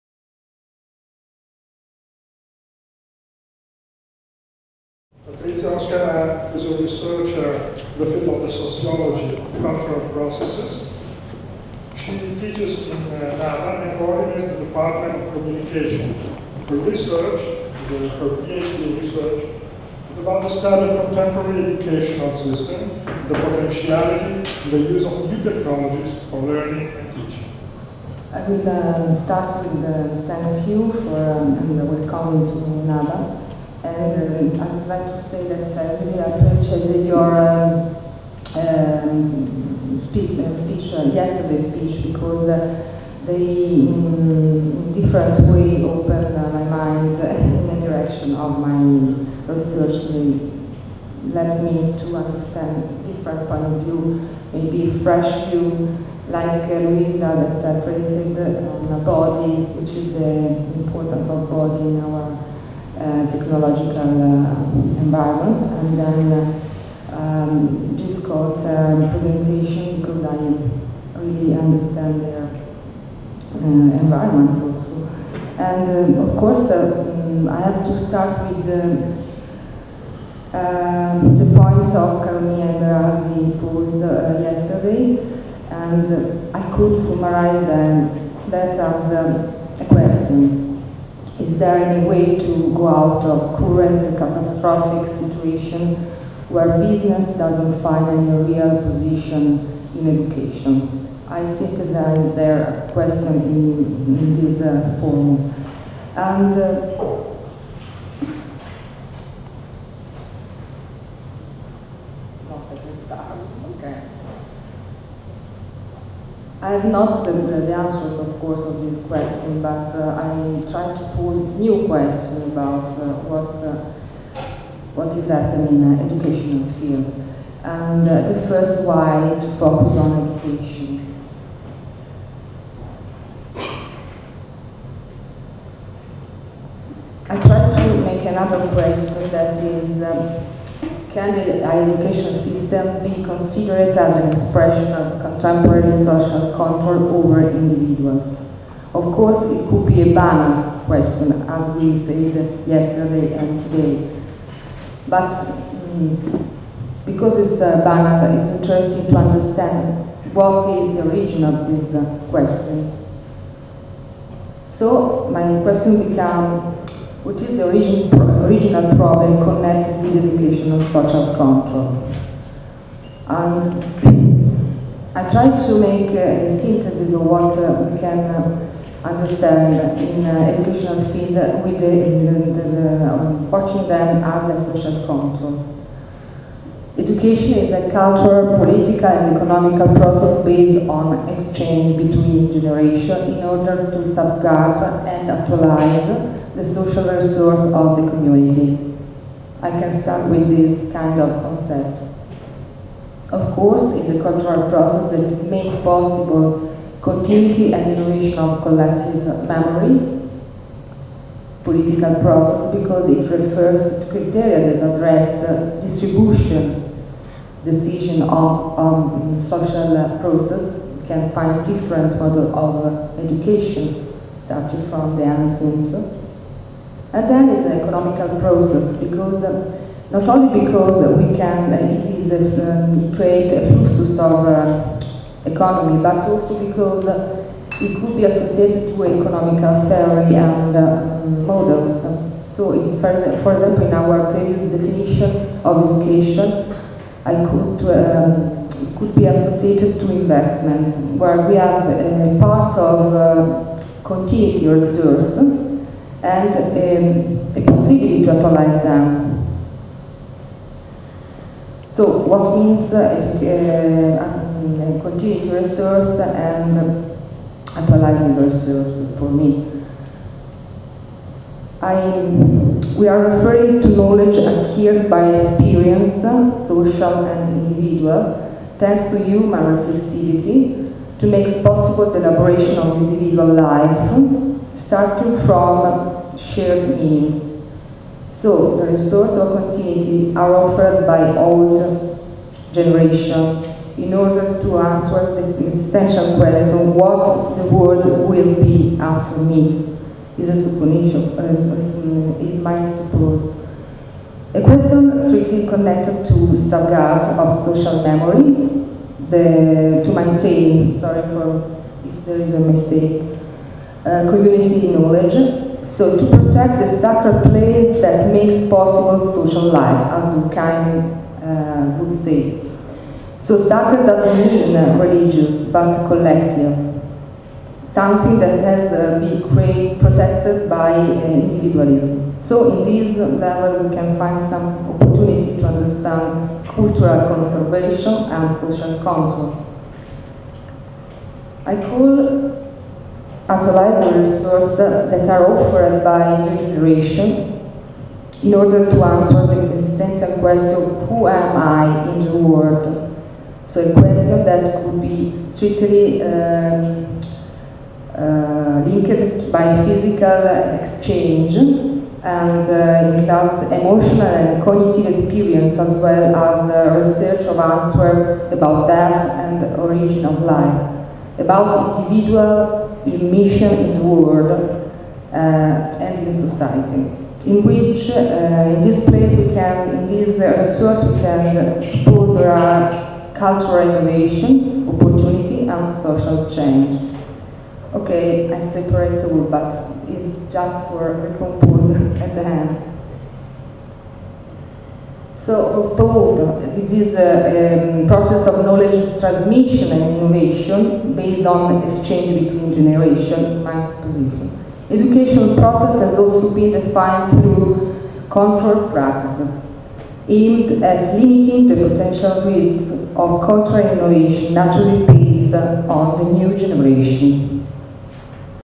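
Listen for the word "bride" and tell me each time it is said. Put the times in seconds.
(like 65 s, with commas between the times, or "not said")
not said.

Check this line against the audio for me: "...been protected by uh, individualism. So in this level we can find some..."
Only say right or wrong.
right.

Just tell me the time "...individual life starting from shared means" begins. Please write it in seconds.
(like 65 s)
282 s.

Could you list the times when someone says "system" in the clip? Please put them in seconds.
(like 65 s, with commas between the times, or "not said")
22 s, 142 s.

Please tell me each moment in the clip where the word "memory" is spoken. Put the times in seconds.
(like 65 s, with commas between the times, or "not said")
209 s, 308 s.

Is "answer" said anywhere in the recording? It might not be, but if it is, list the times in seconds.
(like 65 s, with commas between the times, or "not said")
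117 s, 294 s, 349 s, 367 s.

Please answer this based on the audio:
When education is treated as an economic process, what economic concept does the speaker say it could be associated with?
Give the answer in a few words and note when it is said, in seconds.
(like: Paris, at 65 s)
investment, at 250 s.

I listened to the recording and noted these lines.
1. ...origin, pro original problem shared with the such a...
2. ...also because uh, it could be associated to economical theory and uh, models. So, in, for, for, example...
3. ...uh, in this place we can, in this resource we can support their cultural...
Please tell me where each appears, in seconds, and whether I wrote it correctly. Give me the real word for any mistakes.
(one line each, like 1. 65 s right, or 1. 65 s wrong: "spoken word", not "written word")
1. 167 s wrong: "connected", not "shared"
2. 236 s right
3. 378 s right.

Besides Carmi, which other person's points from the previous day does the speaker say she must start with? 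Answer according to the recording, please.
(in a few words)
Berardi.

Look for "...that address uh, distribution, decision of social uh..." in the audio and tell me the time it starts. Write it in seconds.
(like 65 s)
214 s.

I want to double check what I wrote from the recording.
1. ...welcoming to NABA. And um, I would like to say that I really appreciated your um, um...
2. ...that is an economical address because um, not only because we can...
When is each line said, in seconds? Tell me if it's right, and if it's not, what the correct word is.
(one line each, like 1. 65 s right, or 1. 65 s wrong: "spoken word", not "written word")
1. 31 s right
2. 227 s wrong: "process", not "address".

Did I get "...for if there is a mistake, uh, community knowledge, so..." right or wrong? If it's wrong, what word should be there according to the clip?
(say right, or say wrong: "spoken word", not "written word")
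right.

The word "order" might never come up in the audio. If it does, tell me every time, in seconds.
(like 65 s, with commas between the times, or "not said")
193 s, 294 s, 348 s.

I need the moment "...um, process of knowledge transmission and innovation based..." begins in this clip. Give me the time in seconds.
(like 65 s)
397 s.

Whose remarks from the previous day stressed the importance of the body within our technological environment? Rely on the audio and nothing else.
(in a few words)
Luisa.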